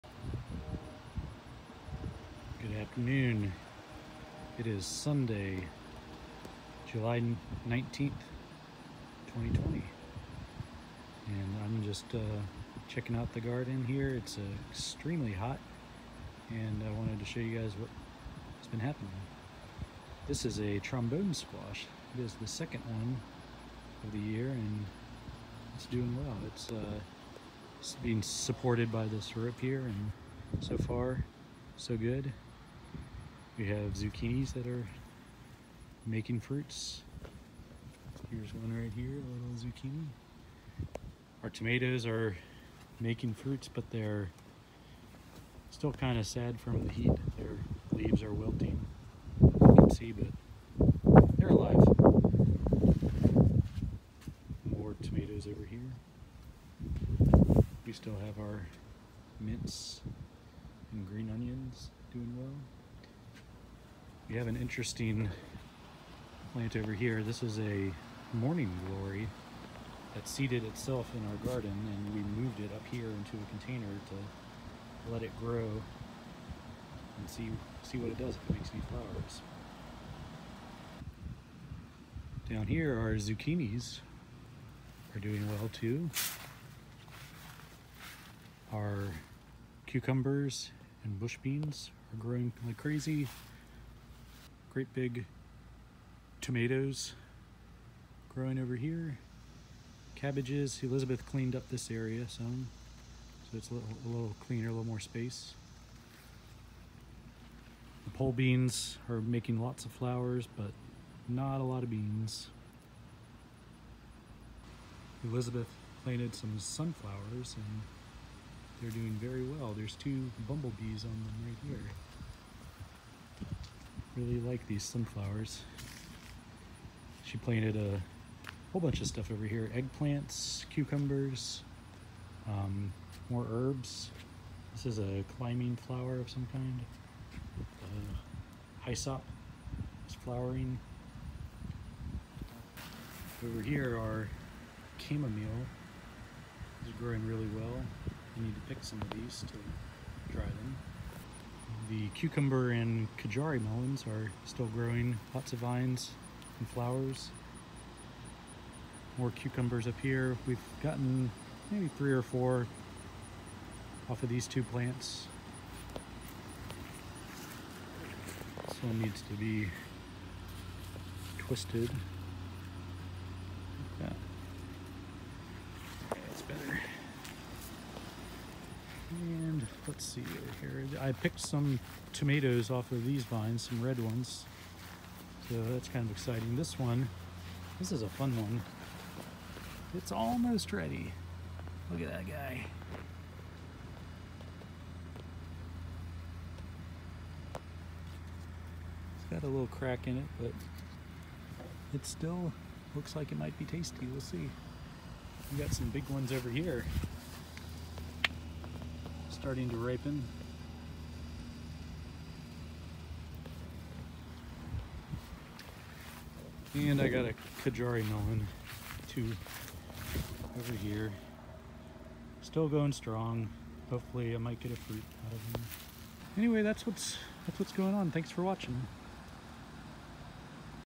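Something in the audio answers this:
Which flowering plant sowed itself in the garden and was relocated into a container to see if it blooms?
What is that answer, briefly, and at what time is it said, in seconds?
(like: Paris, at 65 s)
Morning glory, at 68 s.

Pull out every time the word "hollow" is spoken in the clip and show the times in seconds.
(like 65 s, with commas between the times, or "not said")
not said.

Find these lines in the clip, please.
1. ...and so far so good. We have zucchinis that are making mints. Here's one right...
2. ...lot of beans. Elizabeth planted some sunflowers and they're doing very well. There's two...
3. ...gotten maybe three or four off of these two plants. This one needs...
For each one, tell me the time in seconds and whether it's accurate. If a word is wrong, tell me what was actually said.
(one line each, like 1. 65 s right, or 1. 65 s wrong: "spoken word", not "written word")
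1. 29 s wrong: "fruits", not "mints"
2. 111 s right
3. 160 s right.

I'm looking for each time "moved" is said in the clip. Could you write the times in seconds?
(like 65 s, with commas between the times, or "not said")
72 s.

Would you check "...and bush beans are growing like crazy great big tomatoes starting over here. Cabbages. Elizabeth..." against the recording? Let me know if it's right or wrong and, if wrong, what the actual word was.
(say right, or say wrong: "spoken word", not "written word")
wrong: "growing", not "starting".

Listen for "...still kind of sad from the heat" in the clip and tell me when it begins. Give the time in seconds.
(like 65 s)
45 s.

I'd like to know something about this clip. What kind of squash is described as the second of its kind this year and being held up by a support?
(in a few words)
Trombone squash.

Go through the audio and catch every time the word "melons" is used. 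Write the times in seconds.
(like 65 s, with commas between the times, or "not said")
153 s, 218 s.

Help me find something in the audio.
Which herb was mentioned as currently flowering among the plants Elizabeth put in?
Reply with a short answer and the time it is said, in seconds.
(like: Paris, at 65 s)
Hyssop, at 138 s.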